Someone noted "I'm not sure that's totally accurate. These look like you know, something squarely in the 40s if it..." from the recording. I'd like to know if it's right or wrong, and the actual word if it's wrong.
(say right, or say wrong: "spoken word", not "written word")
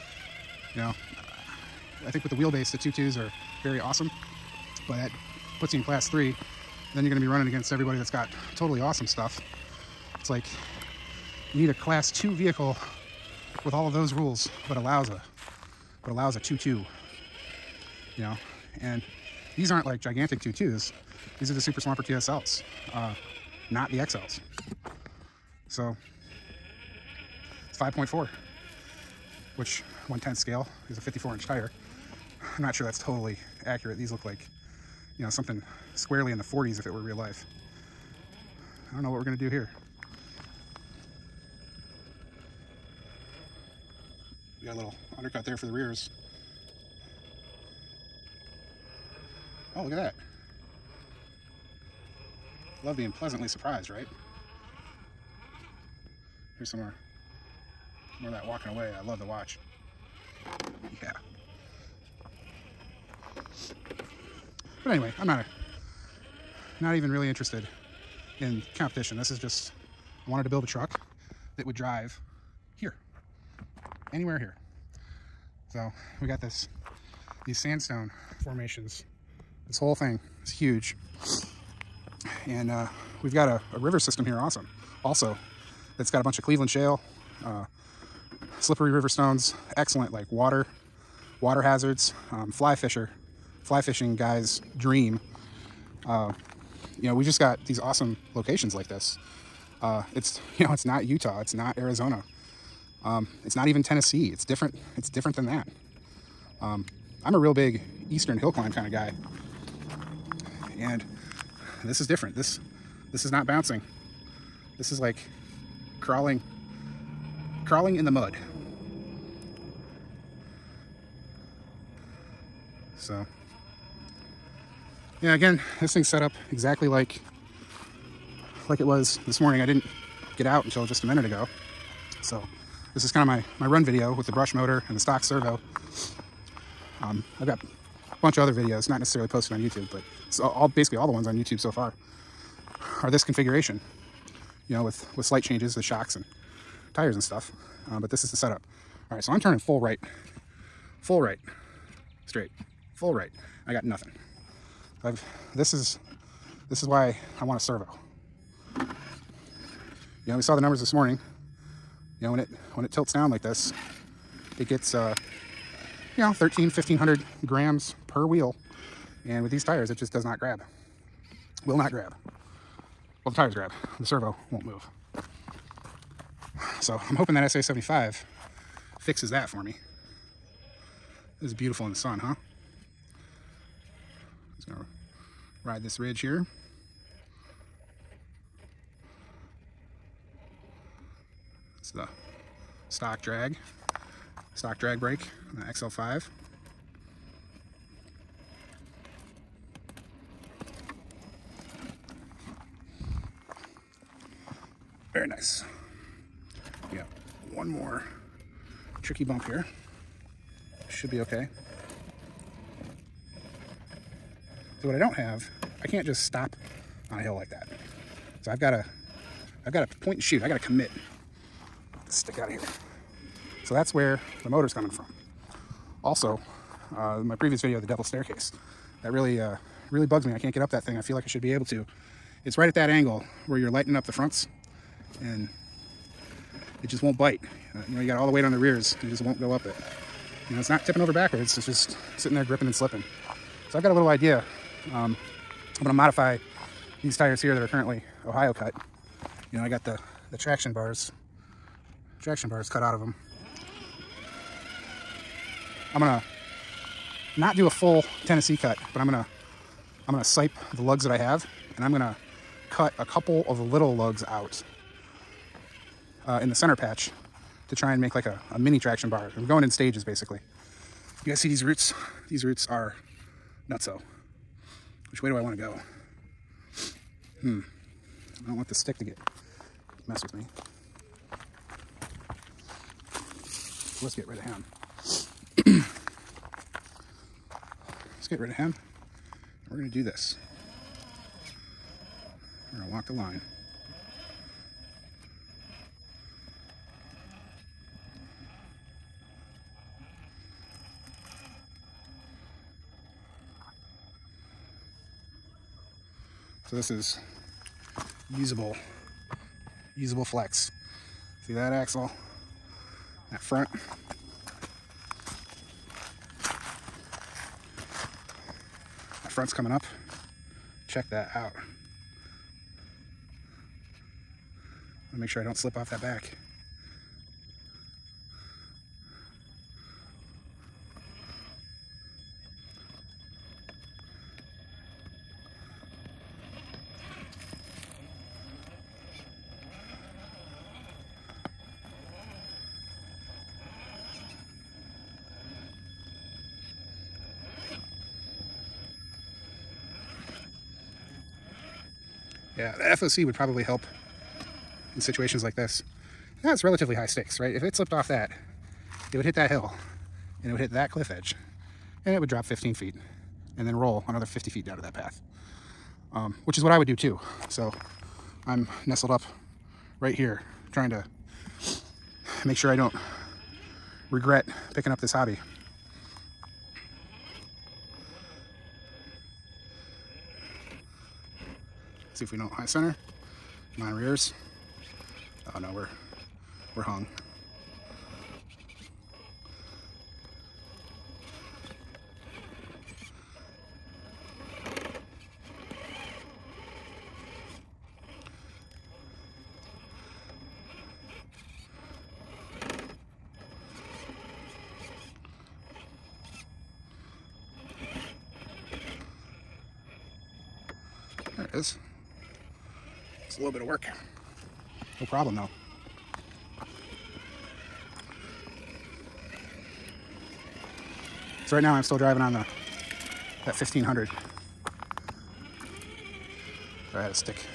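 right.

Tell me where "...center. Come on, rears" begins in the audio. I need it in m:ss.
6:22.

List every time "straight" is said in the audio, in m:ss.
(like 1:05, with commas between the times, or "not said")
2:32.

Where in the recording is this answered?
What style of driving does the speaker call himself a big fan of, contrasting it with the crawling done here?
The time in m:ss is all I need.
1:48.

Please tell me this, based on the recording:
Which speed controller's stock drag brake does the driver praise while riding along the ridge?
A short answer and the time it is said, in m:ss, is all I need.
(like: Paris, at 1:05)
XL5, at 3:15.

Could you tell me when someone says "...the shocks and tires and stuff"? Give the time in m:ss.
2:25.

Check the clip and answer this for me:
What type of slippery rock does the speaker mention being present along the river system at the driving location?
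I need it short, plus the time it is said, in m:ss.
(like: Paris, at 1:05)
Cleveland shale, at 1:26.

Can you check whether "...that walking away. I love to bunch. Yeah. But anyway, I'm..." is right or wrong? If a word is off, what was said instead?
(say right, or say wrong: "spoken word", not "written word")
wrong: "watch", not "bunch".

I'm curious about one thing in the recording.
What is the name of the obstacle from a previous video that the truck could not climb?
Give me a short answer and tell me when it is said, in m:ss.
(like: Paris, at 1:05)
Devil's Staircase, at 3:47.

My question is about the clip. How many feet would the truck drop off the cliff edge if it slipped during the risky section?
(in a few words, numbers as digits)
15.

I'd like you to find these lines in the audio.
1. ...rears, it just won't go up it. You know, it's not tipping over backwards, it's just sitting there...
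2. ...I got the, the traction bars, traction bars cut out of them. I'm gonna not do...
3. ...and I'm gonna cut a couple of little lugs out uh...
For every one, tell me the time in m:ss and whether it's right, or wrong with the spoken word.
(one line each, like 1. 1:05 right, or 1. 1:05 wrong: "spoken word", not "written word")
1. 3:58 right
2. 4:09 right
3. 4:21 right.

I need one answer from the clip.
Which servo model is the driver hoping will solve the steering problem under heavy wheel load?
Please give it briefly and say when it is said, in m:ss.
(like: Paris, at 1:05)
SA75, at 2:57.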